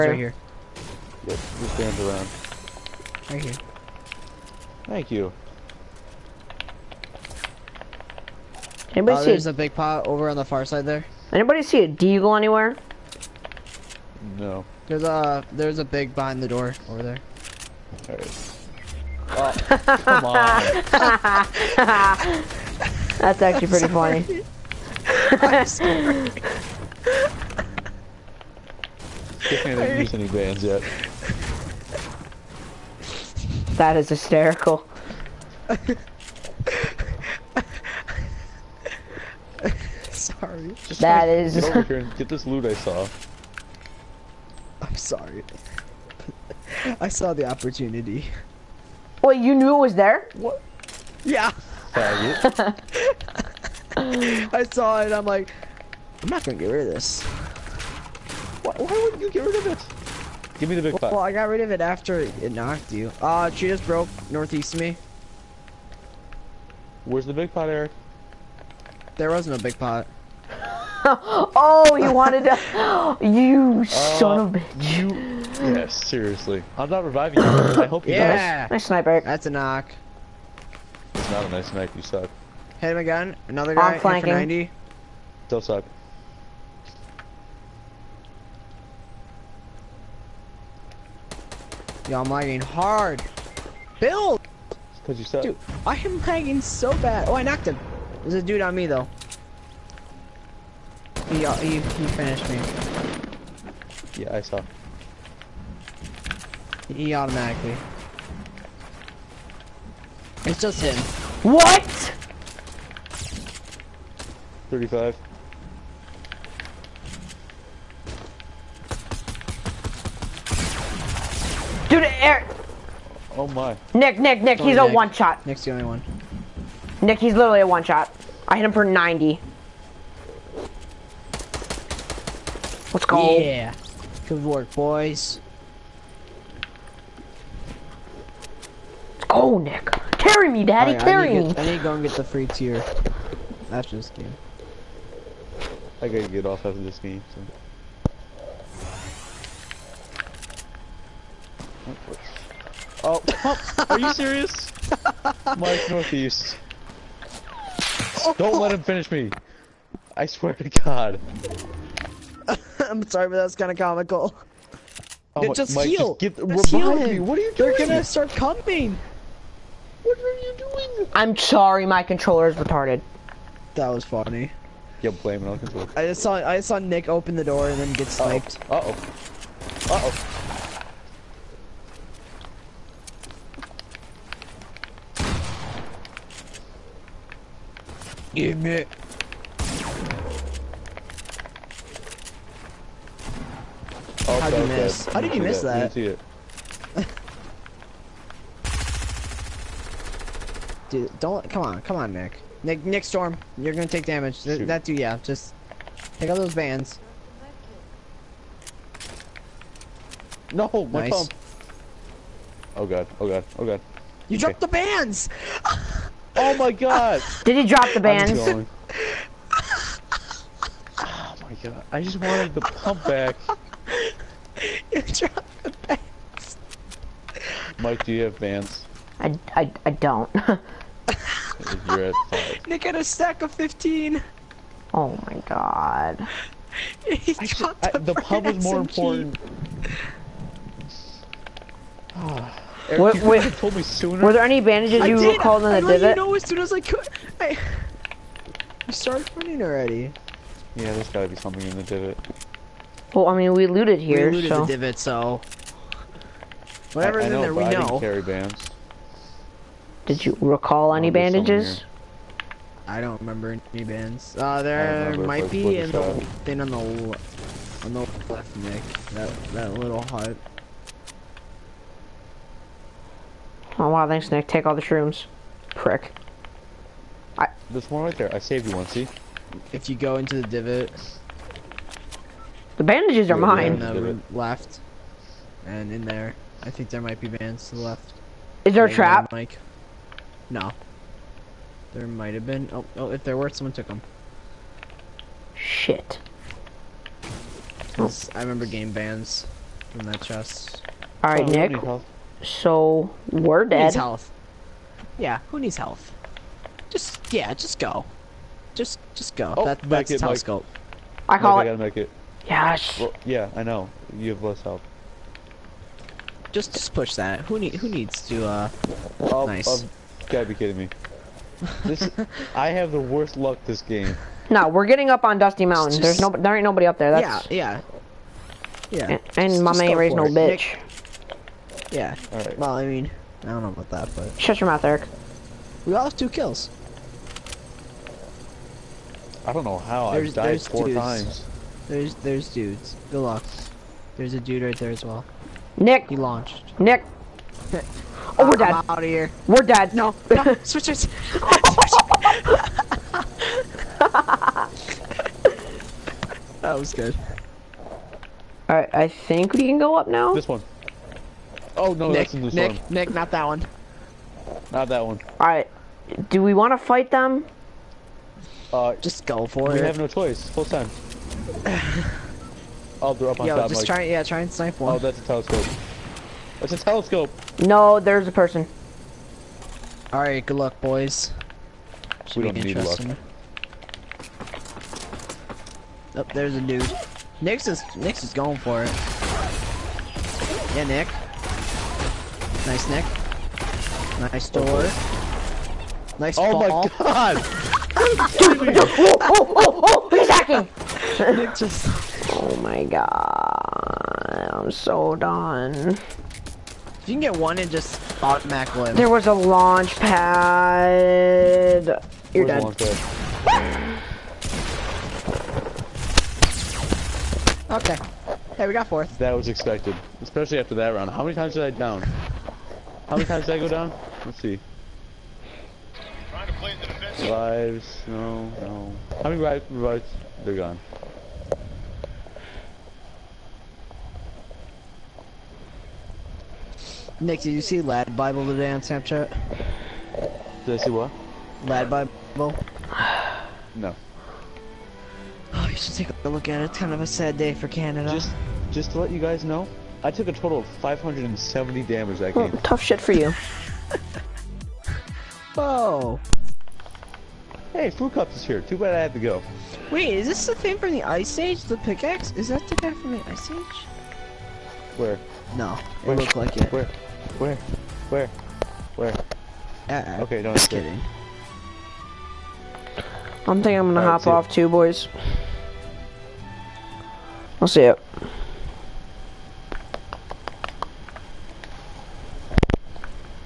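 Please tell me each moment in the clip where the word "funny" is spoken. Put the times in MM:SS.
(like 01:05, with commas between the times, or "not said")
00:23, 02:54.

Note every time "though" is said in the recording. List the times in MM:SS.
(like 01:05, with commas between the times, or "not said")
01:38.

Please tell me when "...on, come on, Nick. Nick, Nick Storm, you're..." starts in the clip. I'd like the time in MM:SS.
03:21.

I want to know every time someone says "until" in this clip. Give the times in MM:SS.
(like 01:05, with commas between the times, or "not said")
not said.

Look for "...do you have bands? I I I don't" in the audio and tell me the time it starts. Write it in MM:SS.
03:48.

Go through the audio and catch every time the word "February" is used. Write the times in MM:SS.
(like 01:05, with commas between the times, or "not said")
not said.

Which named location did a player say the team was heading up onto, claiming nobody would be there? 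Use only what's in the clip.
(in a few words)
Dusty Mountain.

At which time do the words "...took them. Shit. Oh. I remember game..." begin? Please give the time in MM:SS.
04:53.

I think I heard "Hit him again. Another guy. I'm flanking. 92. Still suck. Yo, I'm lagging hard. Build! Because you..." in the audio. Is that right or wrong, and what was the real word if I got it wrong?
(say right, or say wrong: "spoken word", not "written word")
wrong: "90", not "92".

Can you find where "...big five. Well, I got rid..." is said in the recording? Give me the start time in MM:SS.
01:00.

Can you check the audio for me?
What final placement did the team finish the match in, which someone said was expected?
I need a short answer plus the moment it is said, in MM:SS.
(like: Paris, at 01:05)
Fourth, at 06:58.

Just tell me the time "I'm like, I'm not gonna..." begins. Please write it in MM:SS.
00:55.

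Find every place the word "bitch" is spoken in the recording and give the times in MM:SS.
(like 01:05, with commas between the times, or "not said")
01:14, 05:30.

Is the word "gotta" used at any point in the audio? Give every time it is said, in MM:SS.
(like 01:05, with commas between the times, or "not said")
02:26, 04:11, 05:11, 05:20.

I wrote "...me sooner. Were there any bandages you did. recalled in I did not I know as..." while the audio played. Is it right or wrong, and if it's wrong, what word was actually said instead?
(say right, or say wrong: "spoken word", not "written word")
right.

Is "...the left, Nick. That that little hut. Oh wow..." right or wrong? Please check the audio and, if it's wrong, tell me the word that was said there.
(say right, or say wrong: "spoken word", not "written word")
right.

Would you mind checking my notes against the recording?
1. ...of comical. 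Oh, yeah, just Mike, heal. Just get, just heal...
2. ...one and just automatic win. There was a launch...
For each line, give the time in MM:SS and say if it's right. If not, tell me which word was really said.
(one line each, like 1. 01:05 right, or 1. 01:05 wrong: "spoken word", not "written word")
1. 02:43 right
2. 06:47 right.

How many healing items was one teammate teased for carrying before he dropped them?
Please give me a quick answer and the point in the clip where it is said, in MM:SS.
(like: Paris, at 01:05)
15, at 03:53.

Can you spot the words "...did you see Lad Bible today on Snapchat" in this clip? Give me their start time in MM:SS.
07:17.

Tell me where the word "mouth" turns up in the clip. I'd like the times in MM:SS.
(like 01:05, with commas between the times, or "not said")
05:34.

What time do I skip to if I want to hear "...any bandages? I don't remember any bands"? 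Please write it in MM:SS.
04:20.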